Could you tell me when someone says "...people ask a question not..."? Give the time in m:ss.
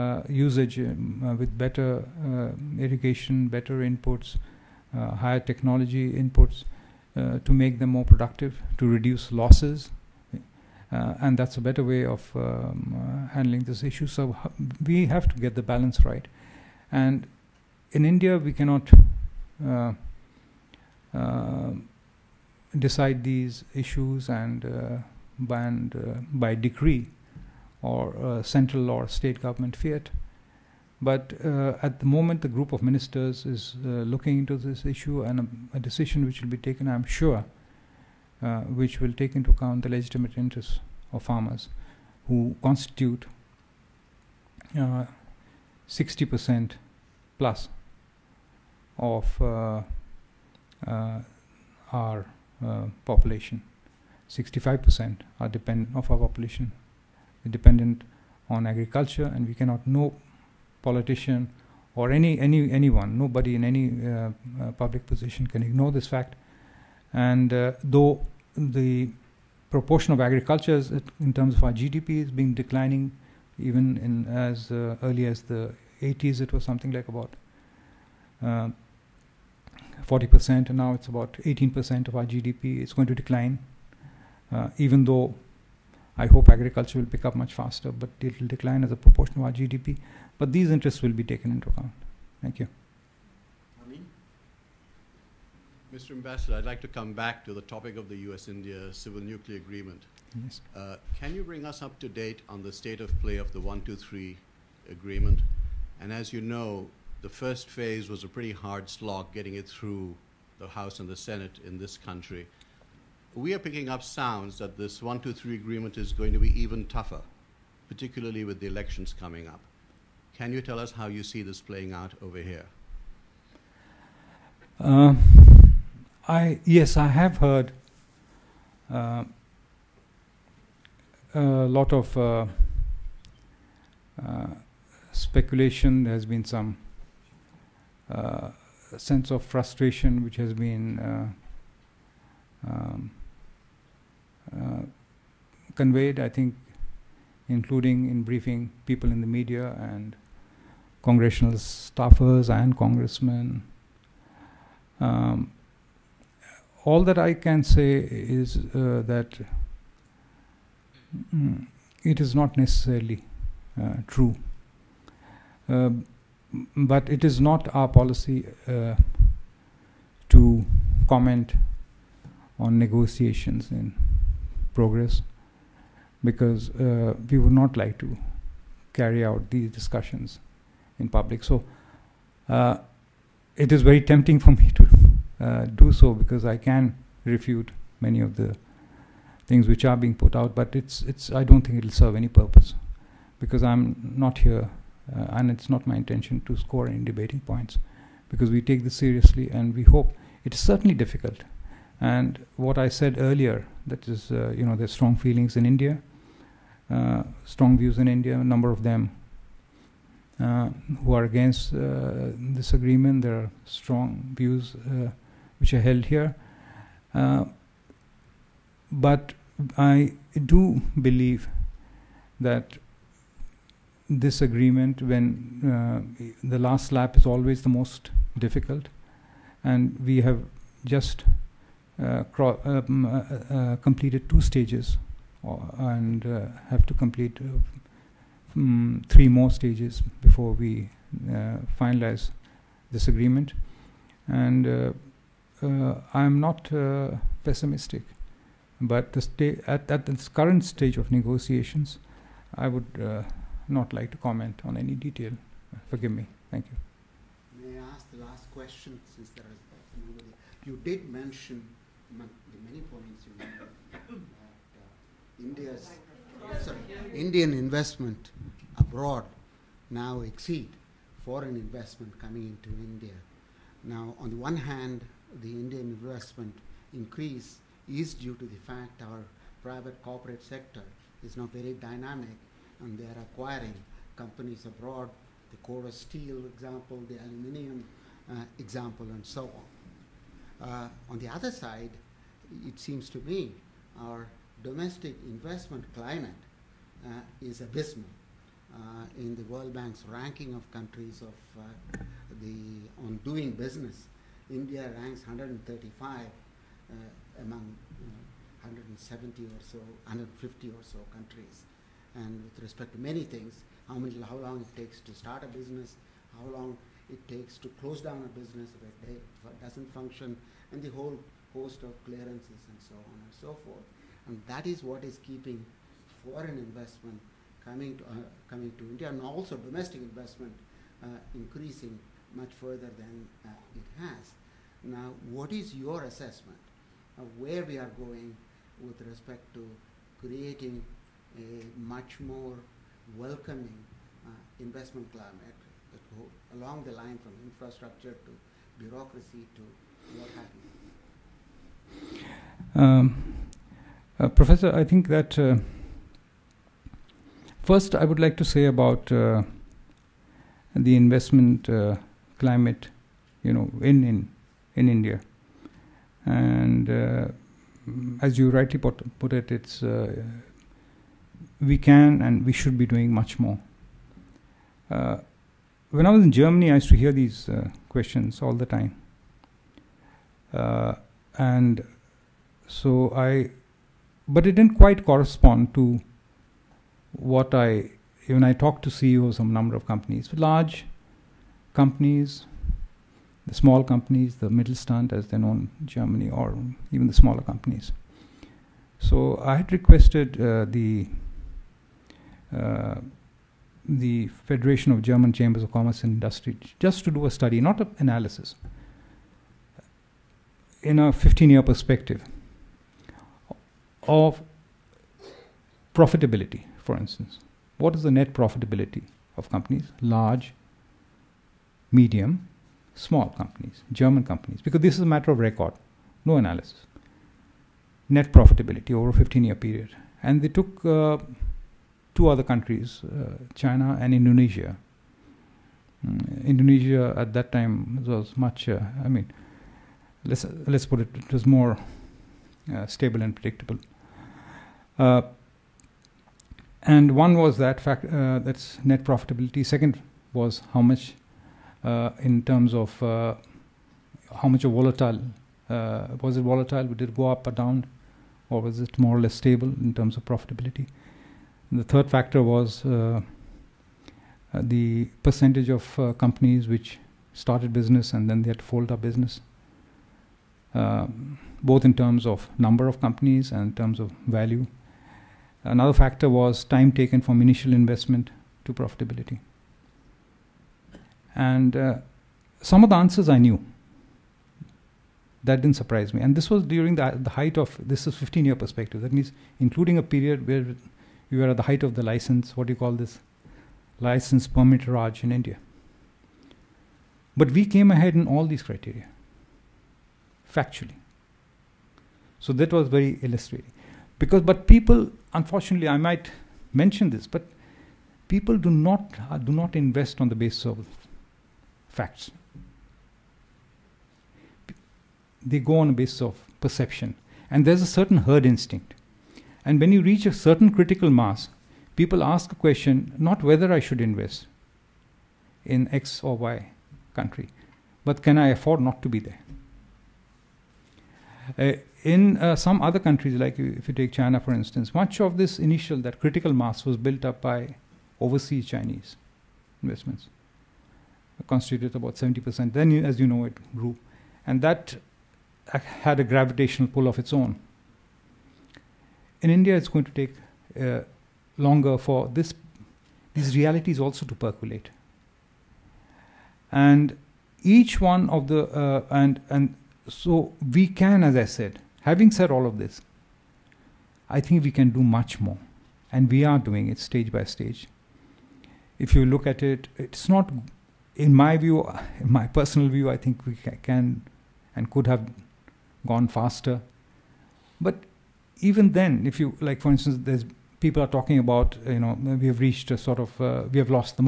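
8:41.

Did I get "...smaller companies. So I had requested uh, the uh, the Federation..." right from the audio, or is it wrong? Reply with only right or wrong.
right.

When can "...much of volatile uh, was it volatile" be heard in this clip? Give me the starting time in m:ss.
7:34.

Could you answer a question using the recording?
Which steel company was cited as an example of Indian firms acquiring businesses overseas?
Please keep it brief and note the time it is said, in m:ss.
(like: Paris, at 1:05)
Corus, at 4:45.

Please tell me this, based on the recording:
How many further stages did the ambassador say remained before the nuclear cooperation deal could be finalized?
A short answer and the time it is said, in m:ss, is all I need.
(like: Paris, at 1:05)
3, at 3:59.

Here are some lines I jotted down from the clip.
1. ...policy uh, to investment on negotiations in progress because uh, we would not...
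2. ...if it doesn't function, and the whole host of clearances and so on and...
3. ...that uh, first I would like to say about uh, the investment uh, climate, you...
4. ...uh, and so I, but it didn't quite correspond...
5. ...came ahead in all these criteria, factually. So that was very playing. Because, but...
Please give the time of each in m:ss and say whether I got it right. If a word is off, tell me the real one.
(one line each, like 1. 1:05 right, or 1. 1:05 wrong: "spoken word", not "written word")
1. 2:47 wrong: "comment", not "investment"
2. 5:19 right
3. 5:55 right
4. 6:20 right
5. 8:17 wrong: "illustrating", not "playing".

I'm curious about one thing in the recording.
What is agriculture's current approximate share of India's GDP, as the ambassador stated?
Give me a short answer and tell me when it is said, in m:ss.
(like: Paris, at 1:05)
About 18%, at 1:21.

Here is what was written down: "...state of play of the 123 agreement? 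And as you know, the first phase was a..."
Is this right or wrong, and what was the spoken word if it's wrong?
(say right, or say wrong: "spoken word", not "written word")
right.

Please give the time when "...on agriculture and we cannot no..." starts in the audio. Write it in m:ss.
0:58.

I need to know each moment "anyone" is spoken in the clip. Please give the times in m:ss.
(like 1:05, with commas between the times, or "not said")
1:02.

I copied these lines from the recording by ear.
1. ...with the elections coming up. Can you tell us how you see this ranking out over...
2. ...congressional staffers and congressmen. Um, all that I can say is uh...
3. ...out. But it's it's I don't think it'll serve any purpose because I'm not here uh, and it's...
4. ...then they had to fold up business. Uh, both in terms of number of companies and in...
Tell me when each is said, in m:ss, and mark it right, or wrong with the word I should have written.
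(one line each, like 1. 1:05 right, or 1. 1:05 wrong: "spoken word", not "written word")
1. 1:58 wrong: "playing", not "ranking"
2. 2:31 right
3. 3:10 right
4. 7:48 right.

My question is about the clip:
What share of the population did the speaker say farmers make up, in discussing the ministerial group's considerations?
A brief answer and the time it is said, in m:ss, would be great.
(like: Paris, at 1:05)
60% plus, at 0:44.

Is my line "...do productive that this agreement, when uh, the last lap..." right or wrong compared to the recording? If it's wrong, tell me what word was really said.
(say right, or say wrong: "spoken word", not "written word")
wrong: "believe", not "productive".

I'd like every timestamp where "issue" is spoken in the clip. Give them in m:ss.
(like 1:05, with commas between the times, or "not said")
0:13, 0:23, 0:34.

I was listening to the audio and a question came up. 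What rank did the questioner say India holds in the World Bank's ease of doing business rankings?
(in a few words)
135.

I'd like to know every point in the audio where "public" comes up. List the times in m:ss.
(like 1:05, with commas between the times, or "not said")
1:04, 3:01.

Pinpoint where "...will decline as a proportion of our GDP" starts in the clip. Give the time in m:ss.
1:28.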